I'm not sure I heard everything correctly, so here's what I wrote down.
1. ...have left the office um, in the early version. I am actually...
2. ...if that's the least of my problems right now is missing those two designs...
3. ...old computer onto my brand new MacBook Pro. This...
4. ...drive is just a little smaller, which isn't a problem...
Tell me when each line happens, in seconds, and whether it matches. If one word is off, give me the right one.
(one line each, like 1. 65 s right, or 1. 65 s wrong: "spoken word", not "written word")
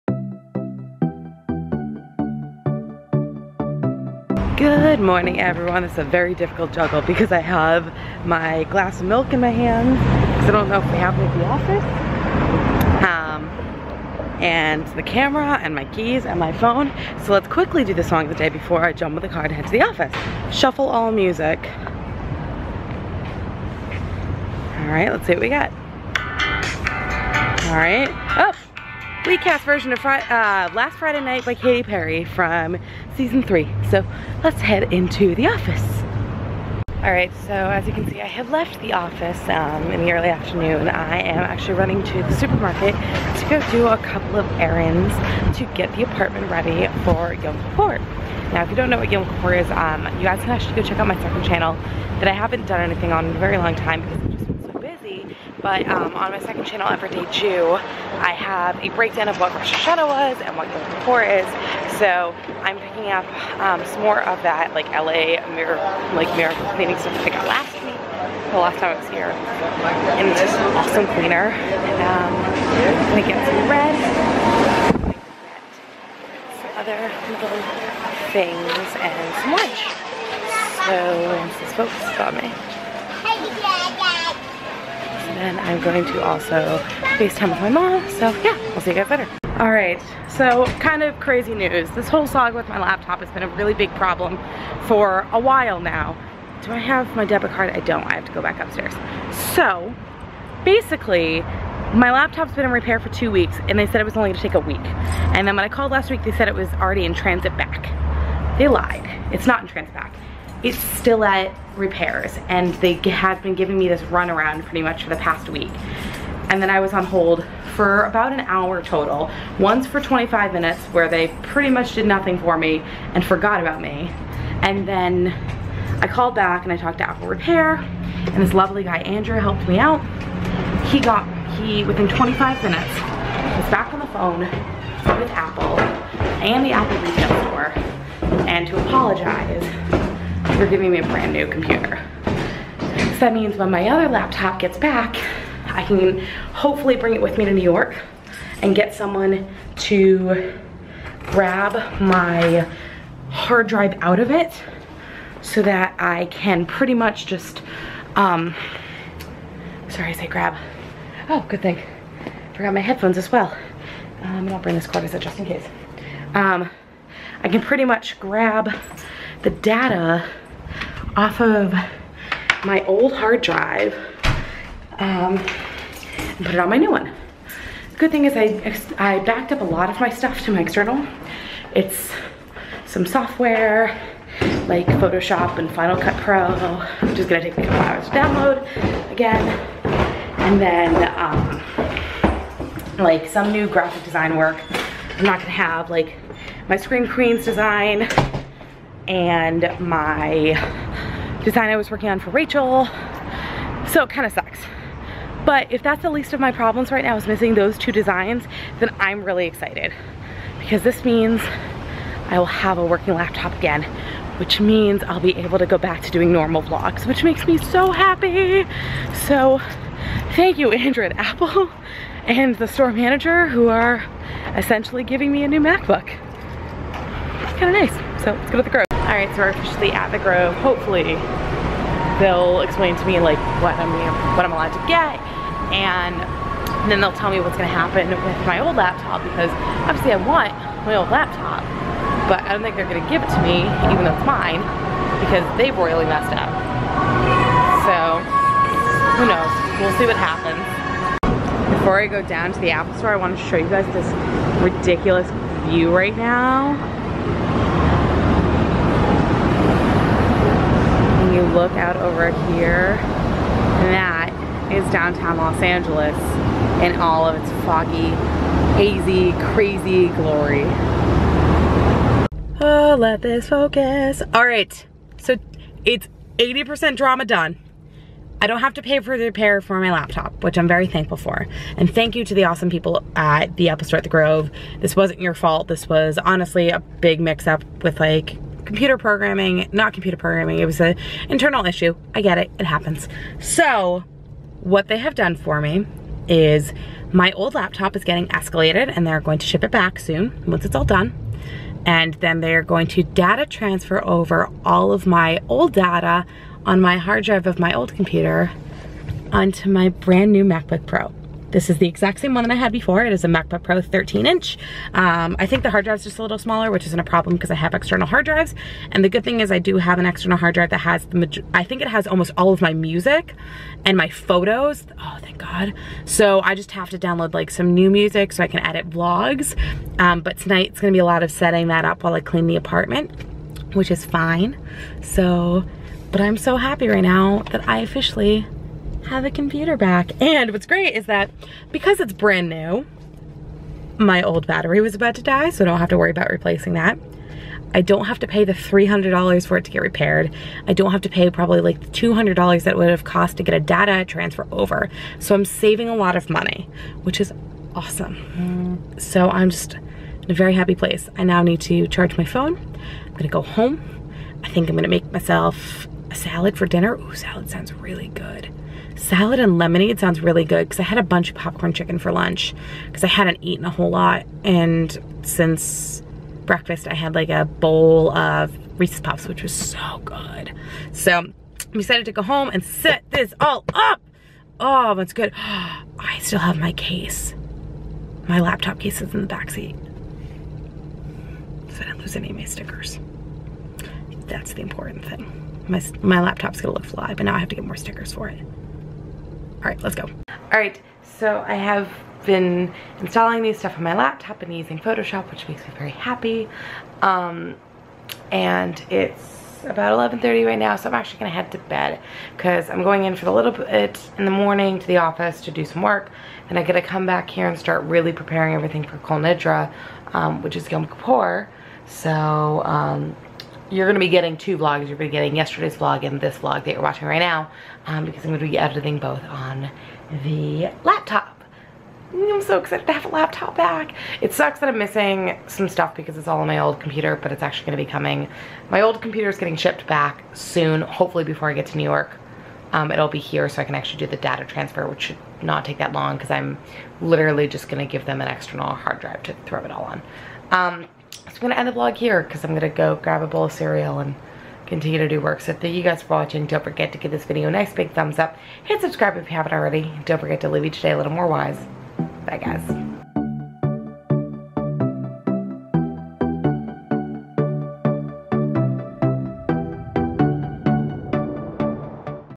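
1. 38 s wrong: "afternoon", not "version"
2. 205 s right
3. 307 s right
4. 315 s right.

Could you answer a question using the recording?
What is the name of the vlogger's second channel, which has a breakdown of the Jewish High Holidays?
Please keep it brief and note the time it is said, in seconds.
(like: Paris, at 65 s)
Everyday Jew, at 56 s.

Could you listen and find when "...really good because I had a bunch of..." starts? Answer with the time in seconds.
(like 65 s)
370 s.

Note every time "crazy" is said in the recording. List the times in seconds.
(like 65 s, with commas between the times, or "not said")
91 s, 269 s.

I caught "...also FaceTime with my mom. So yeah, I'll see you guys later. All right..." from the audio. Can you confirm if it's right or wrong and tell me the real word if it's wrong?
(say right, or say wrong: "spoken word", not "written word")
right.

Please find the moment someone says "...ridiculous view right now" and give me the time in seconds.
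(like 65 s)
254 s.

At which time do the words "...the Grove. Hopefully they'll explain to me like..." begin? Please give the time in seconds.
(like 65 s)
230 s.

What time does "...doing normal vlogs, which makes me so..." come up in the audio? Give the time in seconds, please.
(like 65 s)
216 s.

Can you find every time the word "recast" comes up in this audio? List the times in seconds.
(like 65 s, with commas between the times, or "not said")
29 s.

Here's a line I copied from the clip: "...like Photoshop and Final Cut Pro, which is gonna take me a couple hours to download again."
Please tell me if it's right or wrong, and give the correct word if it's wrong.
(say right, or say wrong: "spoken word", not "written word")
right.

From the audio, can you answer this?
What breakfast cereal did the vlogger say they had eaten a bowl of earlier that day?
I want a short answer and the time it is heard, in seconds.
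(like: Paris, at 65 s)
Reese's Puffs, at 378 s.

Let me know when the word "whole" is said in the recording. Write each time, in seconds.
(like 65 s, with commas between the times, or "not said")
92 s, 373 s.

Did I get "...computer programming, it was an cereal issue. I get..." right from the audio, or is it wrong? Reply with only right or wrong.
wrong.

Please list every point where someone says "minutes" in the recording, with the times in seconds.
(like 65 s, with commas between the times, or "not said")
120 s, 132 s.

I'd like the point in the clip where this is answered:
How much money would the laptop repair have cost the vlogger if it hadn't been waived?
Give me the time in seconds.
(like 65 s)
348 s.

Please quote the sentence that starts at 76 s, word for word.
Some other little things and some lunch.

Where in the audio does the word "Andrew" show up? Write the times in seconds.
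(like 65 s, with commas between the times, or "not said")
128 s, 220 s.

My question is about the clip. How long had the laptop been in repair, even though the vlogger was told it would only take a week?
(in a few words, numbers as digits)
two weeks.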